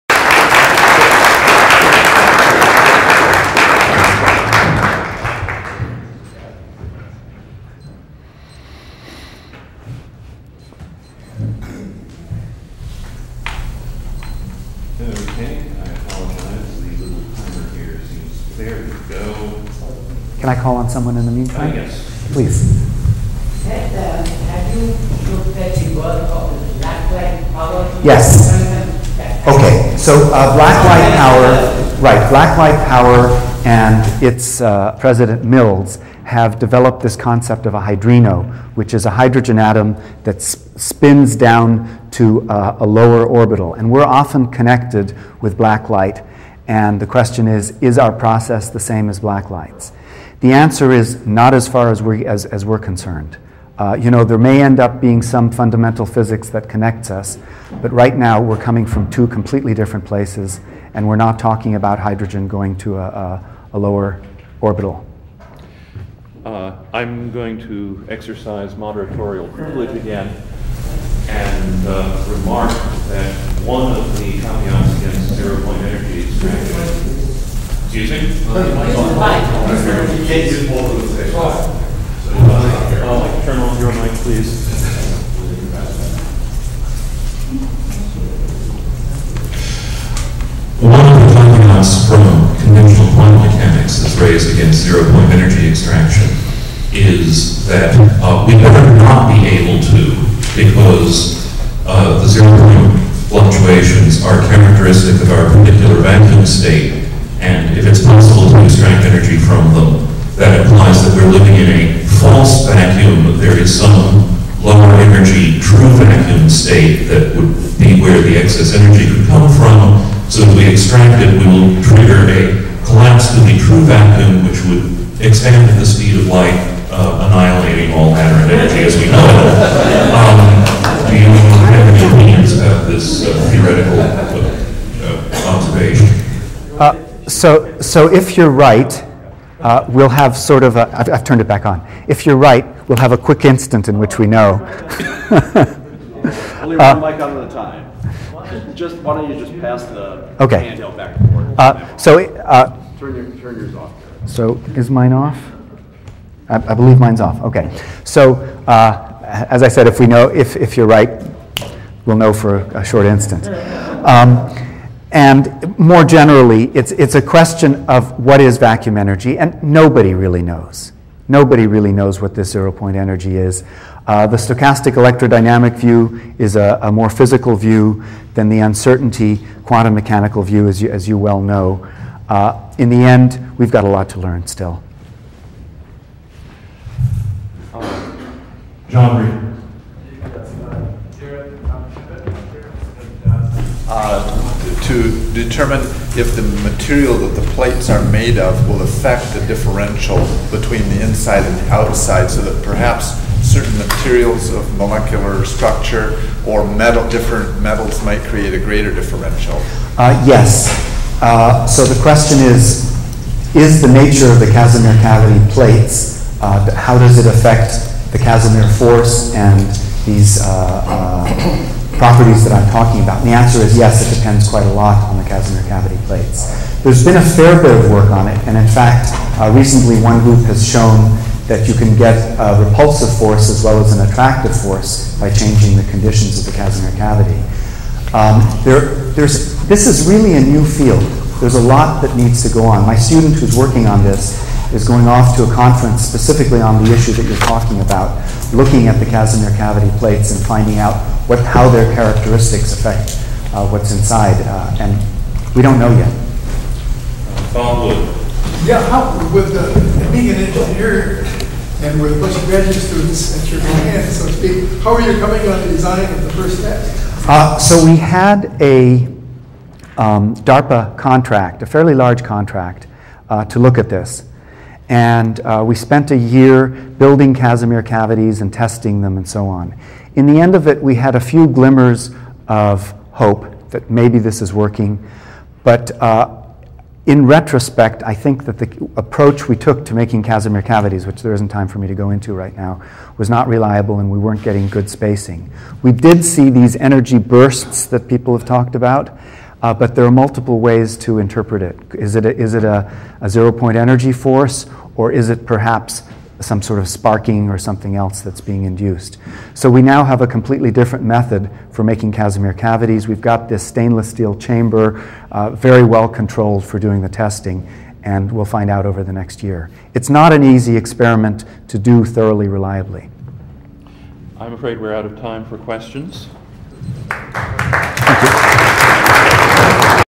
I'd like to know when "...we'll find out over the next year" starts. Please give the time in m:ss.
5:18.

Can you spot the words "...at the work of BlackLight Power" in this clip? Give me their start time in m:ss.
0:25.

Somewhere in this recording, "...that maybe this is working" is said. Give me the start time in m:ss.
4:43.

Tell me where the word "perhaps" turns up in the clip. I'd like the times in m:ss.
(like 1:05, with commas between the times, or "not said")
3:22, 5:05.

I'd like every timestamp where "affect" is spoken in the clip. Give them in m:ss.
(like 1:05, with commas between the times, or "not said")
3:18, 3:37, 4:12.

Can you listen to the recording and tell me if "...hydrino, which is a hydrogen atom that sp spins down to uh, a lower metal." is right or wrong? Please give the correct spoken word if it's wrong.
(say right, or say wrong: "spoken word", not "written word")
wrong: "orbital", not "metal".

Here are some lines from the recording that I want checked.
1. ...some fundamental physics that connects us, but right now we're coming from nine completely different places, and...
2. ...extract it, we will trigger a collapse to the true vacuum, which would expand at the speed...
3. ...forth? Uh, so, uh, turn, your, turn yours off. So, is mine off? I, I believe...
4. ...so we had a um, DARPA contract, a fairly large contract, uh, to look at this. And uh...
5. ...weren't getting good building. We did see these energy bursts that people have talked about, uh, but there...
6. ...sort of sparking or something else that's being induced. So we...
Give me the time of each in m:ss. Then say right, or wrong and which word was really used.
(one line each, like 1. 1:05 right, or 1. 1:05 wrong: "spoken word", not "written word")
1. 0:55 wrong: "two", not "nine"
2. 2:00 right
3. 2:31 right
4. 4:27 right
5. 4:54 wrong: "spacing", not "building"
6. 5:06 right.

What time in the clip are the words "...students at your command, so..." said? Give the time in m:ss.
4:22.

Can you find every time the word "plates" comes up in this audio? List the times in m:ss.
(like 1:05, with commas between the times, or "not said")
3:17, 3:35, 3:46, 4:09.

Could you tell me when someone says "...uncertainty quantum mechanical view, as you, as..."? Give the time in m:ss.
2:58.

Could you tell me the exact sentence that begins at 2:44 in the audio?
Um, and more generally, it's, it's a question of what is vacuum energy, and nobody really knows.